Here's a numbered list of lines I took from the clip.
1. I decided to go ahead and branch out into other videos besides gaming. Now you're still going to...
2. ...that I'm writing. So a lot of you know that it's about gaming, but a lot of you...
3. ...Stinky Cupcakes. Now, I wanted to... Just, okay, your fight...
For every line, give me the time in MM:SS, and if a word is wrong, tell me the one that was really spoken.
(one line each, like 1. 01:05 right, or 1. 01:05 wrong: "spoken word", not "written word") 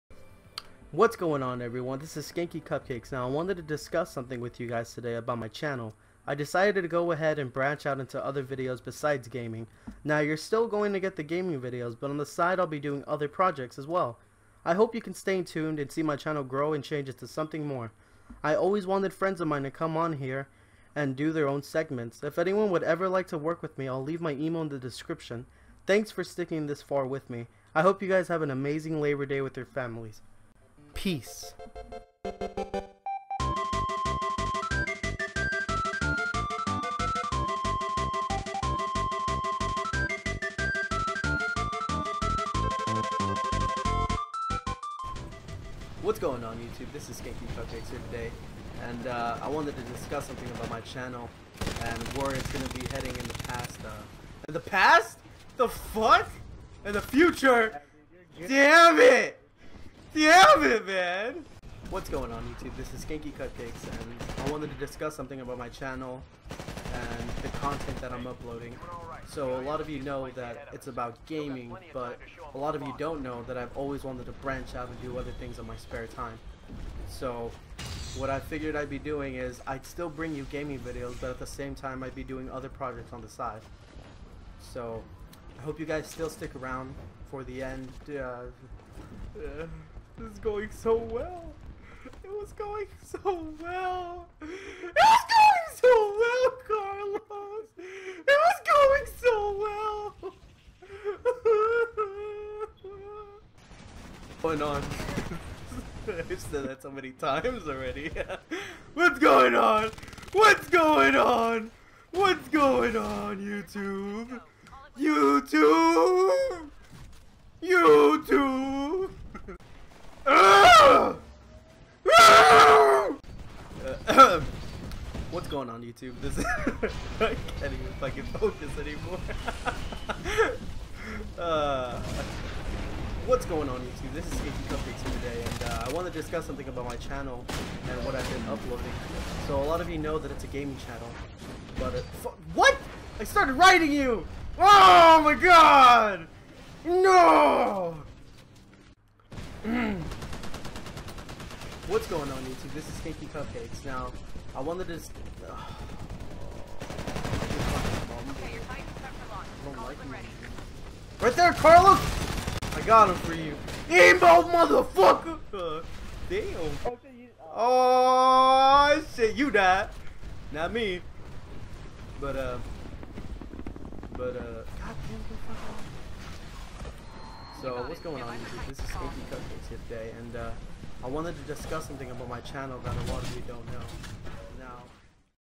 1. 00:06 right
2. 01:08 wrong: "uploading", not "writing"
3. 02:32 right.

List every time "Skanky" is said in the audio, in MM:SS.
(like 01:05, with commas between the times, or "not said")
00:02, 00:47, 01:03.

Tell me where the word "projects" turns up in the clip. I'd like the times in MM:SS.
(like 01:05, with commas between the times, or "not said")
00:13, 01:22.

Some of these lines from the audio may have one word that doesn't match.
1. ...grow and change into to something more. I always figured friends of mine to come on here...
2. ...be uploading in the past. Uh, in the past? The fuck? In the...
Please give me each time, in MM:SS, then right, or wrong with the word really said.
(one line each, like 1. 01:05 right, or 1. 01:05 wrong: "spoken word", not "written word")
1. 00:16 wrong: "wanted", not "figured"
2. 00:52 wrong: "heading", not "uploading".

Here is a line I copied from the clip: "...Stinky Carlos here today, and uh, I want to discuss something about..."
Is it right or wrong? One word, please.
wrong.